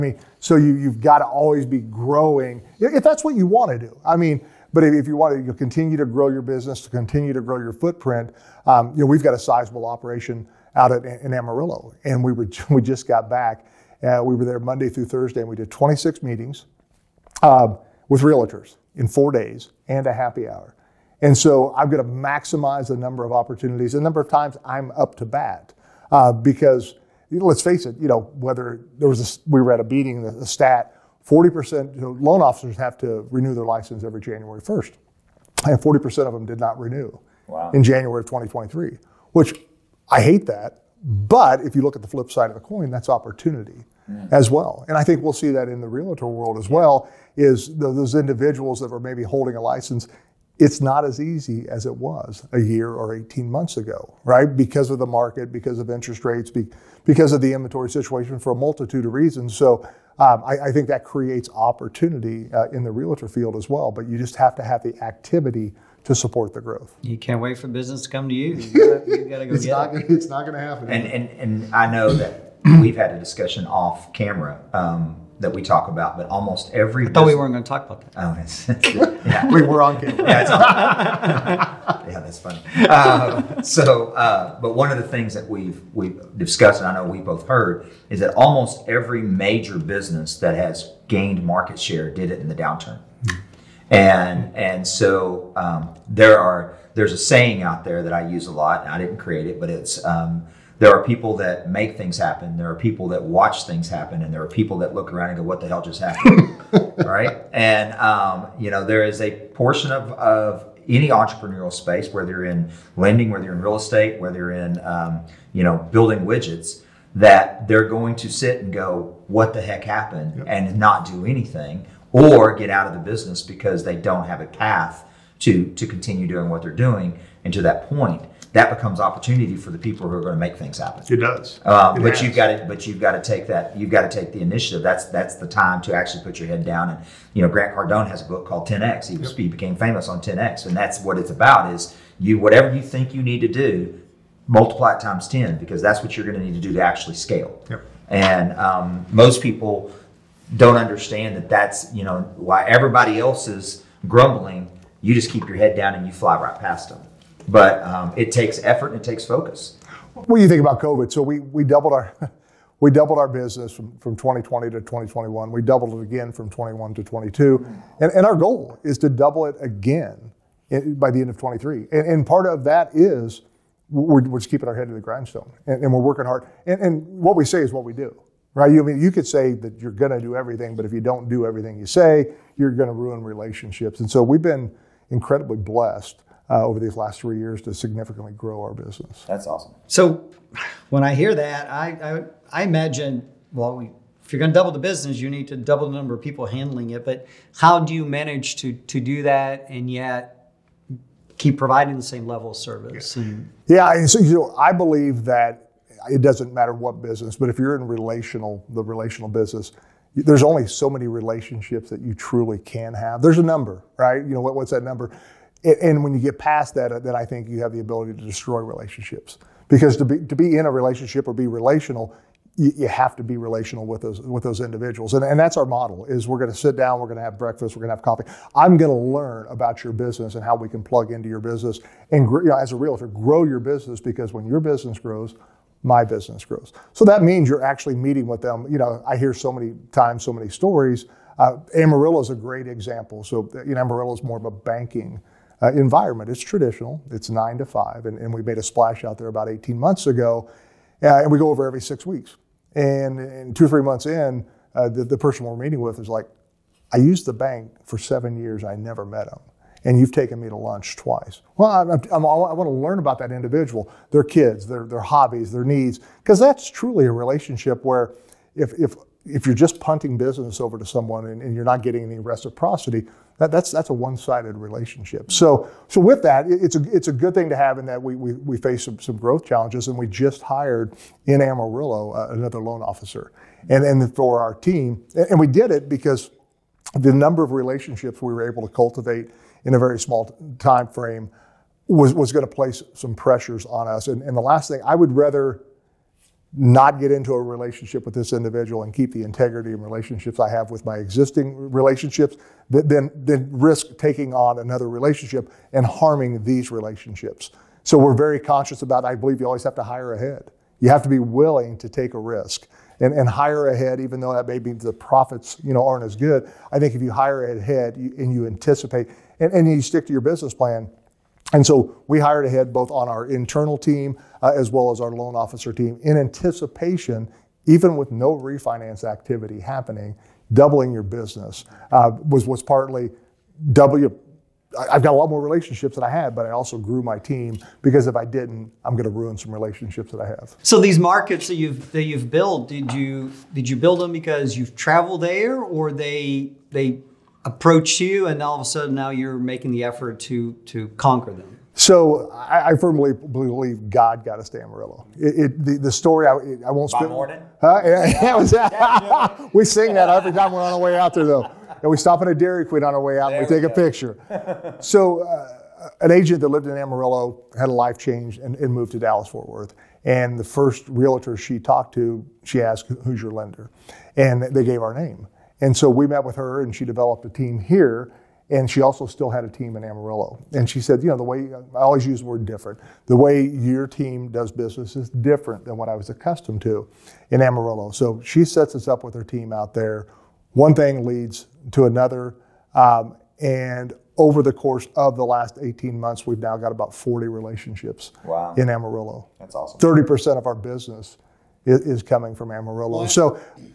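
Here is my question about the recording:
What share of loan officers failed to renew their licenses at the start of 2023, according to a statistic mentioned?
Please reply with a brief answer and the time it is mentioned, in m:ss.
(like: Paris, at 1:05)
40%, at 0:35.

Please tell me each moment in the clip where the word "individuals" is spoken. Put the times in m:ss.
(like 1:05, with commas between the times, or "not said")
0:48, 3:44, 4:23, 4:58.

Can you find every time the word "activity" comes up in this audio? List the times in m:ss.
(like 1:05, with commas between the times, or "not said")
1:05, 5:29.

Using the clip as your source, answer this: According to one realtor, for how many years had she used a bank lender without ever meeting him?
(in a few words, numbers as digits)
7 years.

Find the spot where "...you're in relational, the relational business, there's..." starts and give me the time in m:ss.
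3:27.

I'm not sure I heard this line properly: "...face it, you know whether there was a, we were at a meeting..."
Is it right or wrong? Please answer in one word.
right.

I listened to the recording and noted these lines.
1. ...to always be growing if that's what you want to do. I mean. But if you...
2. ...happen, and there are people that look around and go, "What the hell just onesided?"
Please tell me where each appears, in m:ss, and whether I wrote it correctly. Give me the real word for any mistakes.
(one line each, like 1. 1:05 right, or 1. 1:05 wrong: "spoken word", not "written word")
1. 0:01 right
2. 1:43 wrong: "happened", not "onesided".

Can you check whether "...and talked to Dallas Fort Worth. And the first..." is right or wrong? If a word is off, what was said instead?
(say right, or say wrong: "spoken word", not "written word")
wrong: "moved", not "talked".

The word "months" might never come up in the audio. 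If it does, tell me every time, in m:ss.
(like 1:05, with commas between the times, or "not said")
0:53, 4:09, 4:13, 6:35.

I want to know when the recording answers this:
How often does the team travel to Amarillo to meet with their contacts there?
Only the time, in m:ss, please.
4:11.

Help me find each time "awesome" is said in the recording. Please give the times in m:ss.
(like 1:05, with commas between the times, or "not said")
3:09, 6:39.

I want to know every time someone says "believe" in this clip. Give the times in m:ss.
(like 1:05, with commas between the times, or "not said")
3:24, 5:09, 5:53.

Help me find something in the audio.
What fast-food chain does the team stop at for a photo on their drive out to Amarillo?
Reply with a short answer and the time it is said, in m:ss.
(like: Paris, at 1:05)
Dairy Queen, at 6:02.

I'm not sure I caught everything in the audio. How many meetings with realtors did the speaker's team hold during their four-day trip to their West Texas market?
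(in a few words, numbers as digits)
26.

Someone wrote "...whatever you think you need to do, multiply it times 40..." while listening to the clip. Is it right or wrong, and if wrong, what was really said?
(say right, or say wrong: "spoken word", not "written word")
wrong: "10", not "40".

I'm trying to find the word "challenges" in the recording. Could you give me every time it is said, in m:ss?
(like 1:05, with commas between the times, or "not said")
4:39.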